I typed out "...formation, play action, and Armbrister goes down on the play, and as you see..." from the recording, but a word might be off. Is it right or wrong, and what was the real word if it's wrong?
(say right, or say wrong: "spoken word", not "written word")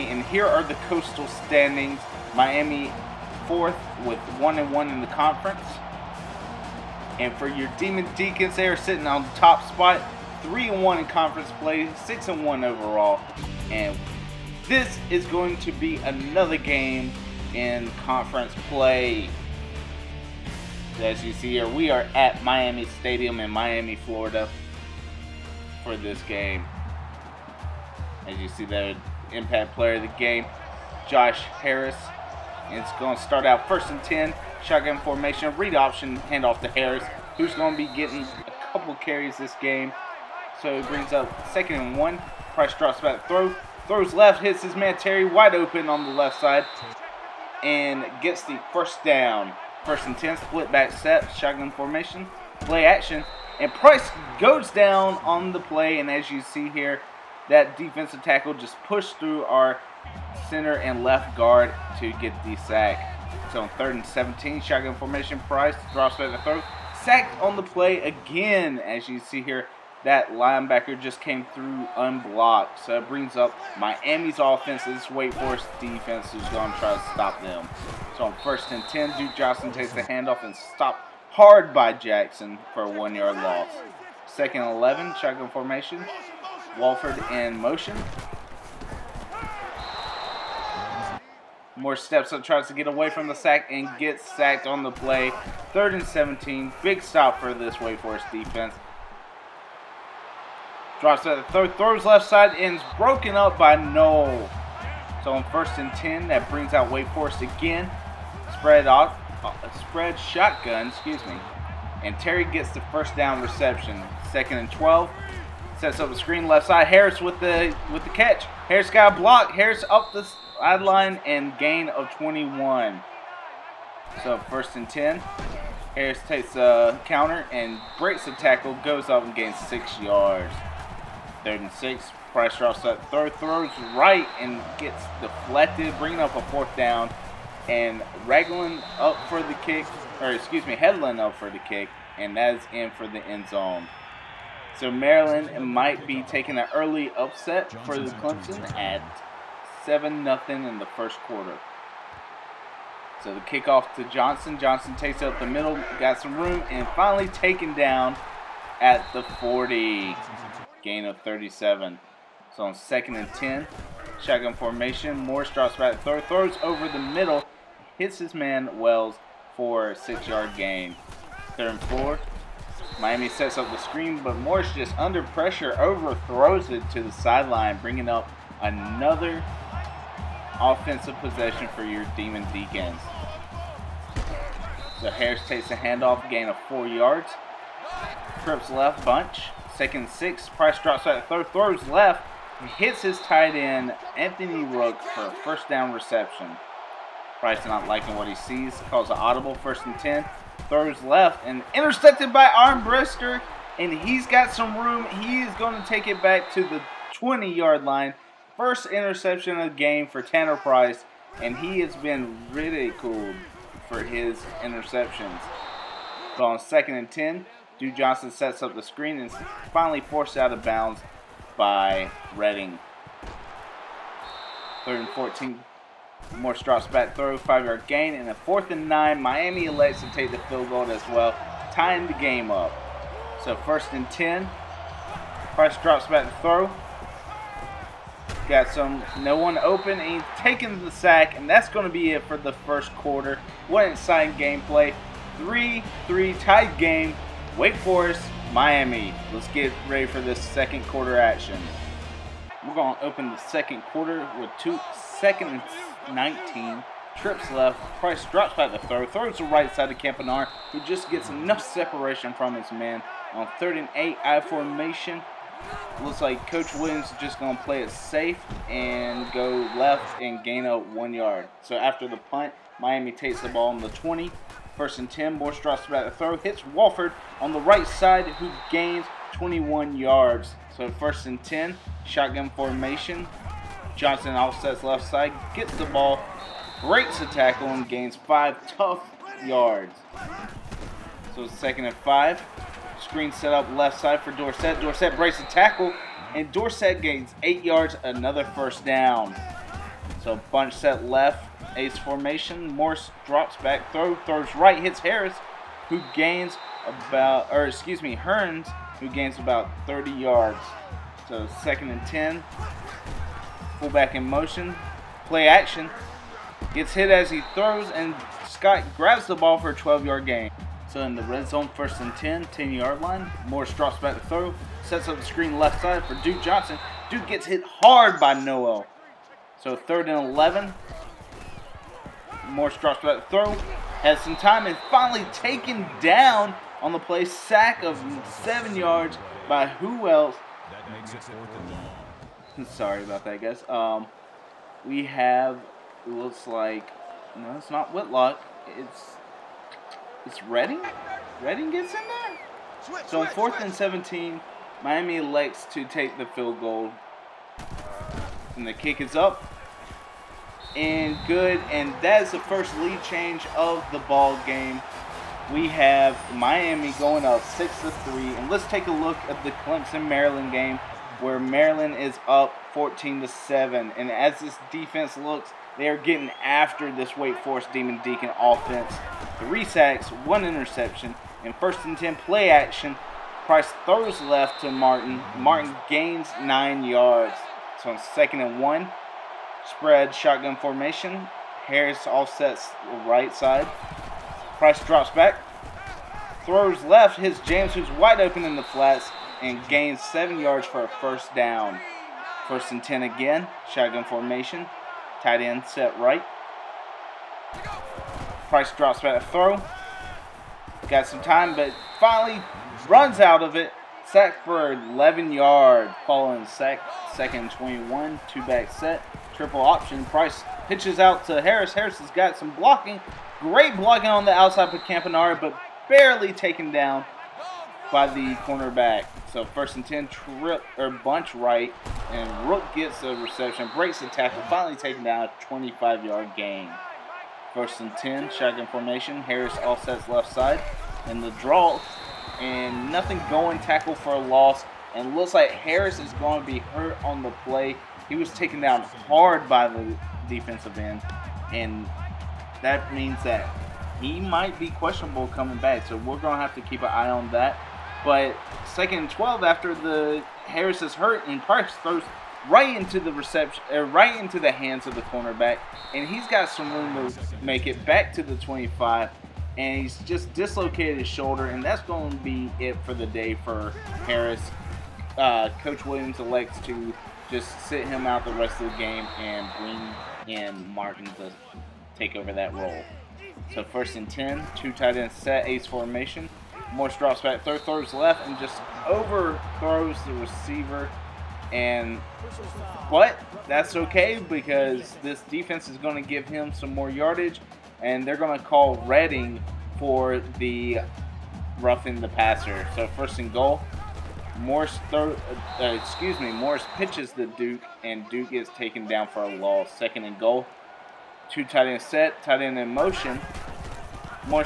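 wrong: "Price", not "Armbrister".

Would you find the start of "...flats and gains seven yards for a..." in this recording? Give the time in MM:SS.
06:38.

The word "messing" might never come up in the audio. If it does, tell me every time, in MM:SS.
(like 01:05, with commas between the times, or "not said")
not said.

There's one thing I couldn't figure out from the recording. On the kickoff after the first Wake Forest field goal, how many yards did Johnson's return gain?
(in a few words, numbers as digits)
37.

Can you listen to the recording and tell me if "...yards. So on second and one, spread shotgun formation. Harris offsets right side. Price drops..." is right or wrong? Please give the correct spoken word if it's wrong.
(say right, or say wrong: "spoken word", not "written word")
right.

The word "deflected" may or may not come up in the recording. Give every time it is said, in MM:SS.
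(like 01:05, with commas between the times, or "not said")
02:15.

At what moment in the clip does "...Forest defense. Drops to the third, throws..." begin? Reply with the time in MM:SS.
01:37.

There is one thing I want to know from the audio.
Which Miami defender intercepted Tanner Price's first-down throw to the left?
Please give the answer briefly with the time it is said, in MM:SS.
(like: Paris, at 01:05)
Armbrister, at 03:22.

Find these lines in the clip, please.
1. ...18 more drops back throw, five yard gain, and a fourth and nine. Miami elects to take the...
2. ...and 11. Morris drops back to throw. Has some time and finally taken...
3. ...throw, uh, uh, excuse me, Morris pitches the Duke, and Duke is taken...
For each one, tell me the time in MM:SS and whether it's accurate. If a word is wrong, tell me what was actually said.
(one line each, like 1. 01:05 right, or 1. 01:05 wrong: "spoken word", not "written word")
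1. 03:45 wrong: "14", not "18"
2. 05:30 right
3. 08:24 right.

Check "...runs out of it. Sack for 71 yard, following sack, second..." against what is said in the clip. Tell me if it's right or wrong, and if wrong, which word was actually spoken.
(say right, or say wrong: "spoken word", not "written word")
wrong: "11", not "71".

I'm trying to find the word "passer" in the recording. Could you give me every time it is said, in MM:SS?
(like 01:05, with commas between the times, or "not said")
08:22.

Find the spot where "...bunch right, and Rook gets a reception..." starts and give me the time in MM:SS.
07:10.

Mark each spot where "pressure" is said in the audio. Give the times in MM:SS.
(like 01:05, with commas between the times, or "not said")
02:55.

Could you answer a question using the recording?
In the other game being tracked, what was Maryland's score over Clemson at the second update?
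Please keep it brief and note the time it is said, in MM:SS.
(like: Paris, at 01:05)
14 to 7, at 06:12.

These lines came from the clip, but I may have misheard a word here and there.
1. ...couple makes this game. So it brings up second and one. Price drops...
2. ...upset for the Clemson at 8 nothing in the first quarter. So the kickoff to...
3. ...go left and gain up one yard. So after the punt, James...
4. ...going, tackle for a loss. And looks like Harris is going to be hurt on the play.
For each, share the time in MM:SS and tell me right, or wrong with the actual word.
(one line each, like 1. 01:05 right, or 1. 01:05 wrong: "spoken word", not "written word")
1. 00:38 wrong: "carries", not "makes"
2. 02:27 wrong: "7", not "8"
3. 04:29 wrong: "Miami", not "James"
4. 07:23 right.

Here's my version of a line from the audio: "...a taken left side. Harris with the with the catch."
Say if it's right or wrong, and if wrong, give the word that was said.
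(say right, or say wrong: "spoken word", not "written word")
wrong: "screen", not "taken".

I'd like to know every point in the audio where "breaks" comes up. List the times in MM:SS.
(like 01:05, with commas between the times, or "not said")
02:07, 04:46, 04:55, 07:13.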